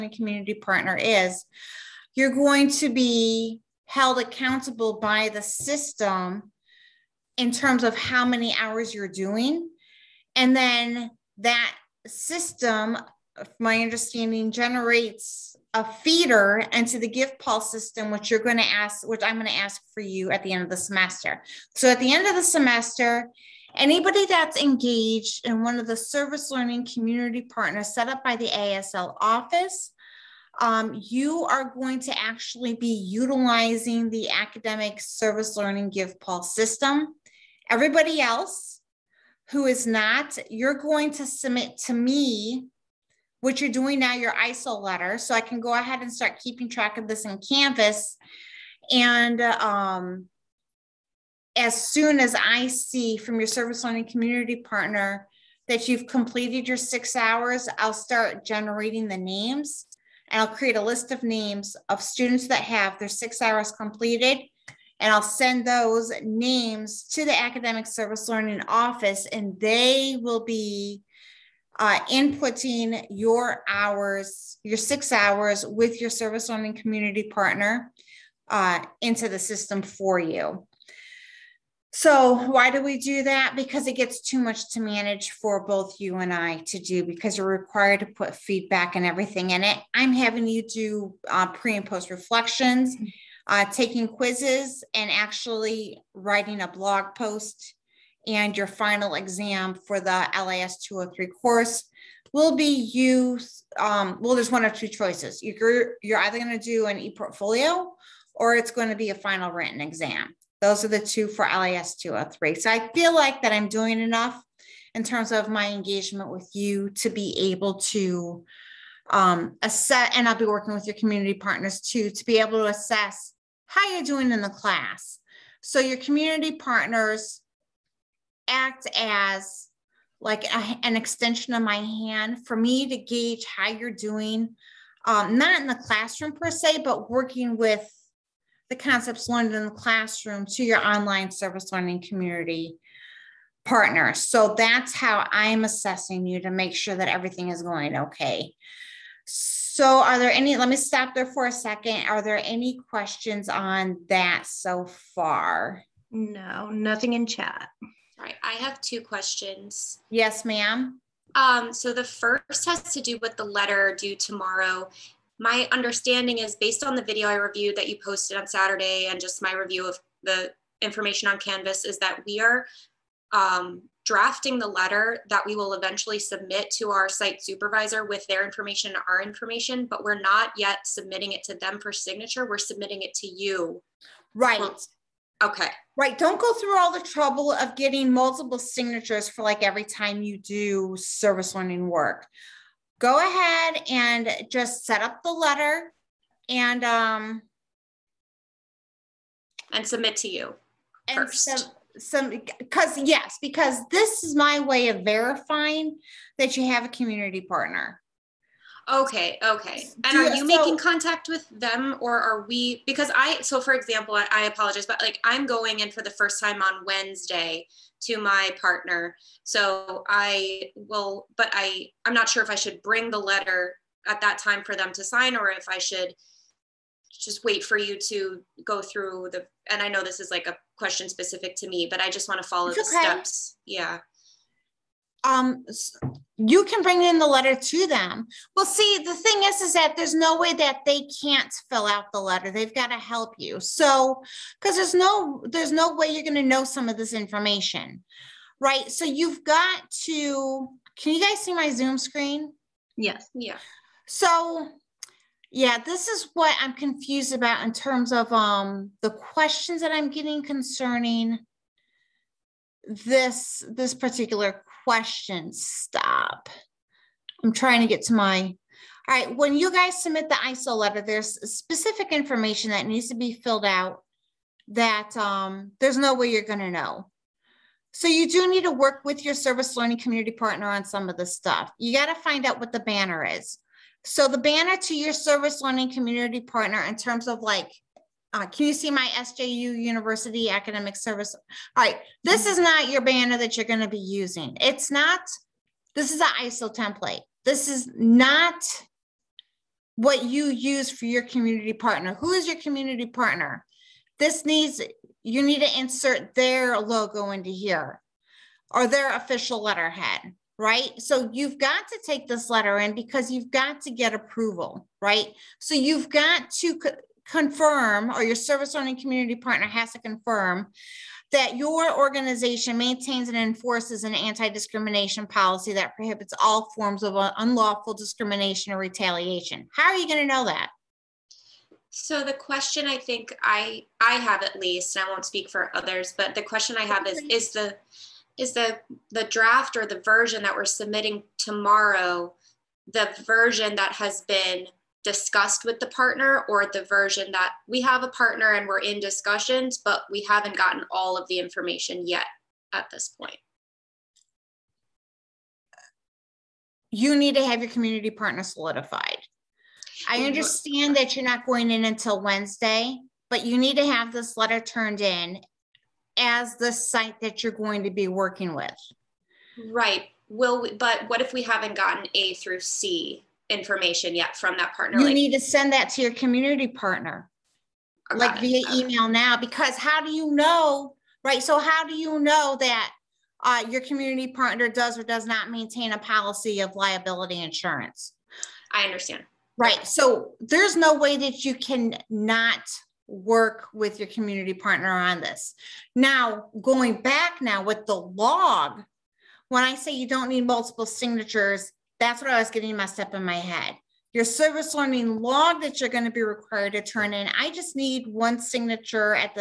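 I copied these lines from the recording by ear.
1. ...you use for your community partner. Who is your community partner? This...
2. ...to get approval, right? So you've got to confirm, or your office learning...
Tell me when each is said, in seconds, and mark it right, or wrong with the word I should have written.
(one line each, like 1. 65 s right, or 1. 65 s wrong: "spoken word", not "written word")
1. 300 s right
2. 313 s wrong: "service", not "office".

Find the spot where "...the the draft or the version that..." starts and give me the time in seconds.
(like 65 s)
338 s.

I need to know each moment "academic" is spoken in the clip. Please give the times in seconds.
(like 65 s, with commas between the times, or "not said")
34 s, 67 s, 290 s.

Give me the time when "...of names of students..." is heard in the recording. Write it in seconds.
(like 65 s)
61 s.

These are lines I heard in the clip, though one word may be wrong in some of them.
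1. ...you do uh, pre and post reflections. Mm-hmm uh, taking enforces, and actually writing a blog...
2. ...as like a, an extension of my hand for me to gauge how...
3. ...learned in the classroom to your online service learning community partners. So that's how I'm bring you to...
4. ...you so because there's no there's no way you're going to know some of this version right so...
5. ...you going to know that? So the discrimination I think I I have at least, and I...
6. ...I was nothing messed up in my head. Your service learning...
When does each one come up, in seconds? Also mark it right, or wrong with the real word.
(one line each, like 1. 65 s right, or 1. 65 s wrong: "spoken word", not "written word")
1. 90 s wrong: "quizzes", not "enforces"
2. 128 s right
3. 139 s wrong: "assessing", not "bring"
4. 243 s wrong: "information", not "version"
5. 329 s wrong: "question", not "discrimination"
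6. 402 s wrong: "getting", not "nothing".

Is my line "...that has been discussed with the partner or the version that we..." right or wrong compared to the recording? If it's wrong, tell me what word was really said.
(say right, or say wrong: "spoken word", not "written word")
right.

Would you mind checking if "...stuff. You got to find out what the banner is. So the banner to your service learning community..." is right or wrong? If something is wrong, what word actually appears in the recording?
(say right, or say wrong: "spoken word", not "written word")
right.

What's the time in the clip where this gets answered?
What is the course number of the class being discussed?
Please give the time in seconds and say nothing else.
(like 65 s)
100 s.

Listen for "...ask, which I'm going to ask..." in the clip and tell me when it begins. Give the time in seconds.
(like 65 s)
18 s.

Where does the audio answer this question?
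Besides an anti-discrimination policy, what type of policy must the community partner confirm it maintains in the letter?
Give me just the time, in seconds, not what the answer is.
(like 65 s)
386 s.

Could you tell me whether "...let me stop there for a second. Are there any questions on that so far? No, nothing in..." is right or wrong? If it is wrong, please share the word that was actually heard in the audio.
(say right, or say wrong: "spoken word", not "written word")
right.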